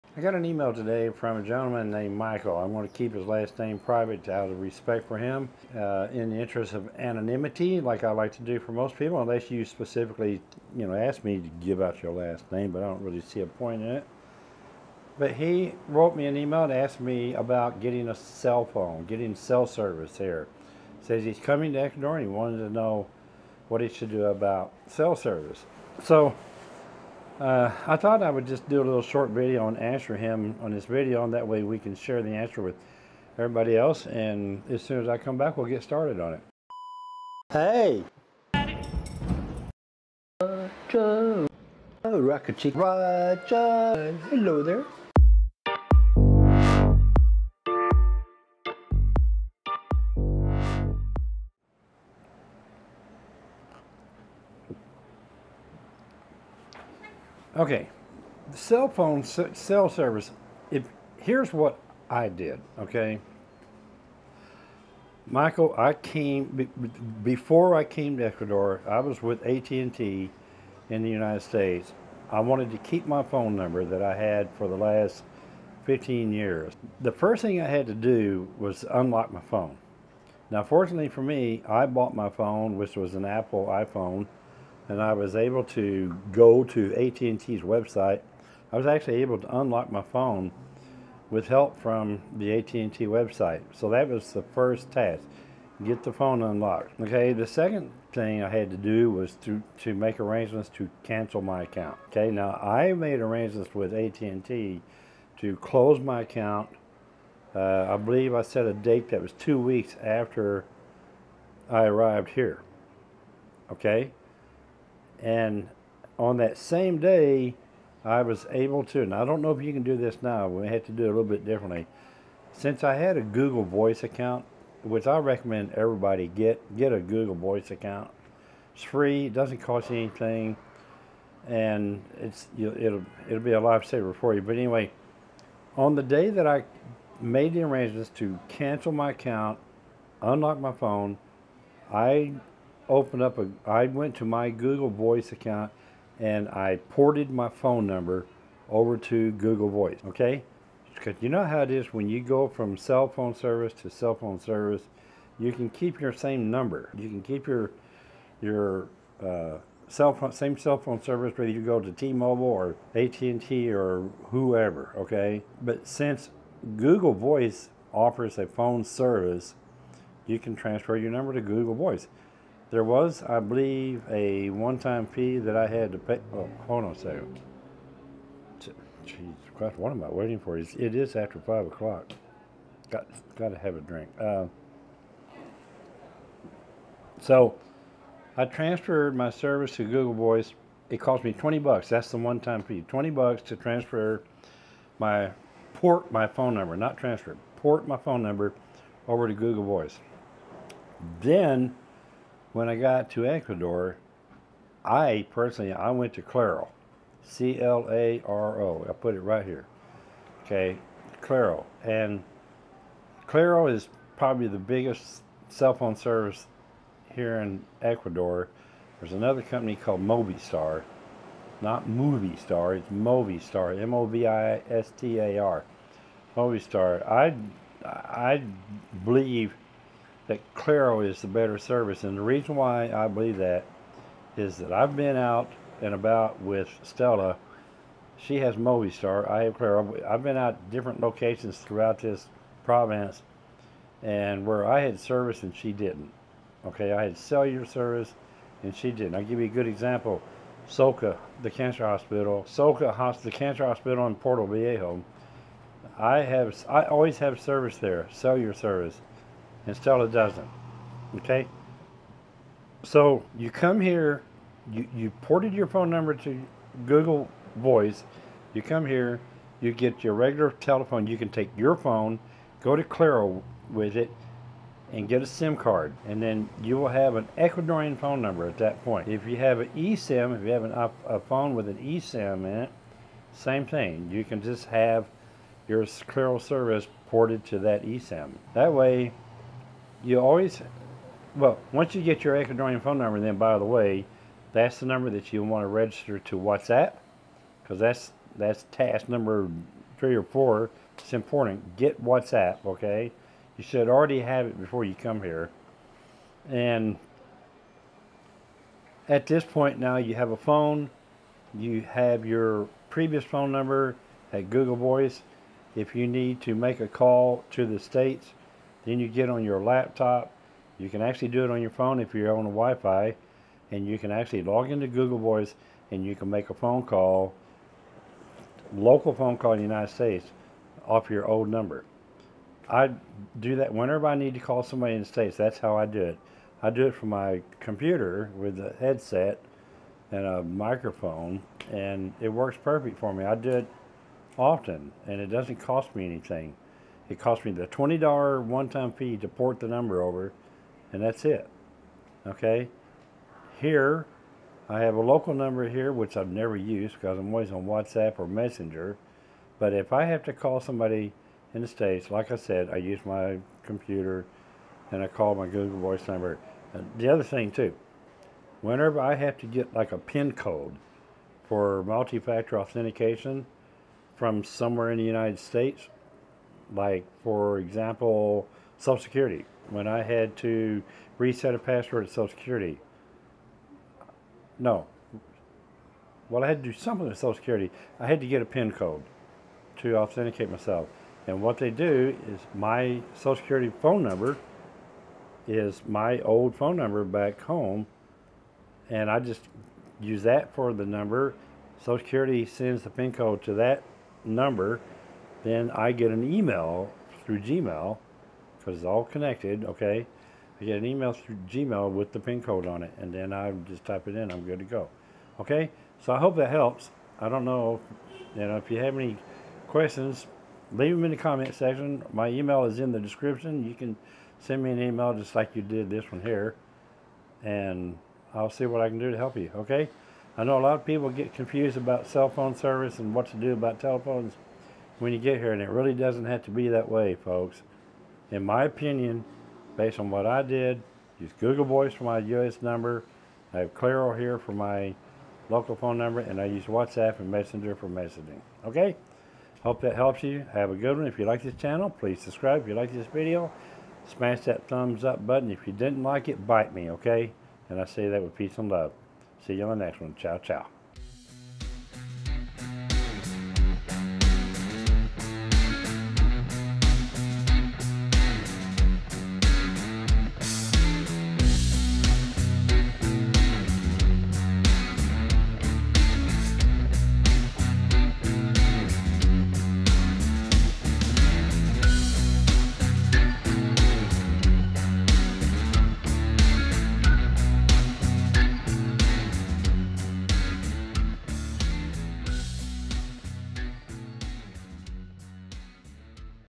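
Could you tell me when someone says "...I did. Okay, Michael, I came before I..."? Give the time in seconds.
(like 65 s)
62 s.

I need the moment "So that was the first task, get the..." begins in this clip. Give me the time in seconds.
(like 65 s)
93 s.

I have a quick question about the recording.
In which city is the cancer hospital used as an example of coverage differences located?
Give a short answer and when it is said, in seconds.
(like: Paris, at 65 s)
Portoviejo, at 254 s.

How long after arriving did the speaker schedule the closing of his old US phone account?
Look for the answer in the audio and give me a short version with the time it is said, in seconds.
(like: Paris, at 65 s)
two weeks, at 109 s.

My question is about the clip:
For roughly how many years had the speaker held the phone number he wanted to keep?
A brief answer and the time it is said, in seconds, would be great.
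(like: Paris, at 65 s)
15, at 75 s.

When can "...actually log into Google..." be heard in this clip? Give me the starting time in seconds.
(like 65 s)
324 s.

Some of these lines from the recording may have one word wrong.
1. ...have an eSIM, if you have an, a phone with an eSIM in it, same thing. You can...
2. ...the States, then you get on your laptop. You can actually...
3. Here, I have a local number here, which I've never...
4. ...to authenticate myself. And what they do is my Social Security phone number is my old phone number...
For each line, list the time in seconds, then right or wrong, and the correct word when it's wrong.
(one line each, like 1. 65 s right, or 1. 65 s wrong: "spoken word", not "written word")
1. 279 s right
2. 317 s right
3. 353 s right
4. 389 s right.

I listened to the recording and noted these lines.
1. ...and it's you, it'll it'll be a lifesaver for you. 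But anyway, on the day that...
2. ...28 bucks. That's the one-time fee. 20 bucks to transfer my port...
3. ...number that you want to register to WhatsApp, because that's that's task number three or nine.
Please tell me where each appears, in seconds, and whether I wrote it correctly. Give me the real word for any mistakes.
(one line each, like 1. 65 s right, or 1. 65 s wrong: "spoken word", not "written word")
1. 131 s right
2. 191 s wrong: "20", not "28"
3. 294 s wrong: "four", not "nine".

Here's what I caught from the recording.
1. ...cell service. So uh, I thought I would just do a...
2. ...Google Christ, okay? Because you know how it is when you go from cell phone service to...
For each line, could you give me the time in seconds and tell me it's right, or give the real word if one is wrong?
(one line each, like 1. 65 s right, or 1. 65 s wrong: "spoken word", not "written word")
1. 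24 s right
2. 149 s wrong: "Voice", not "Christ".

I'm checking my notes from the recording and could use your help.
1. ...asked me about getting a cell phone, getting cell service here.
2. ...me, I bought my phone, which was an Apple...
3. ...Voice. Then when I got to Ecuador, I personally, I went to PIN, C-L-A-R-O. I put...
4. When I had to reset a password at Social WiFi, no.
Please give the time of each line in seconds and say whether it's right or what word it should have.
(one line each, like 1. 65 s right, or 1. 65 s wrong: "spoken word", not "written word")
1. 16 s right
2. 81 s right
3. 199 s wrong: "Claro", not "PIN"
4. 379 s wrong: "Security", not "WiFi".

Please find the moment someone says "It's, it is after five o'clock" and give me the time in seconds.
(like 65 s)
180 s.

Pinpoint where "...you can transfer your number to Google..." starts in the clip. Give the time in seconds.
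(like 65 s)
170 s.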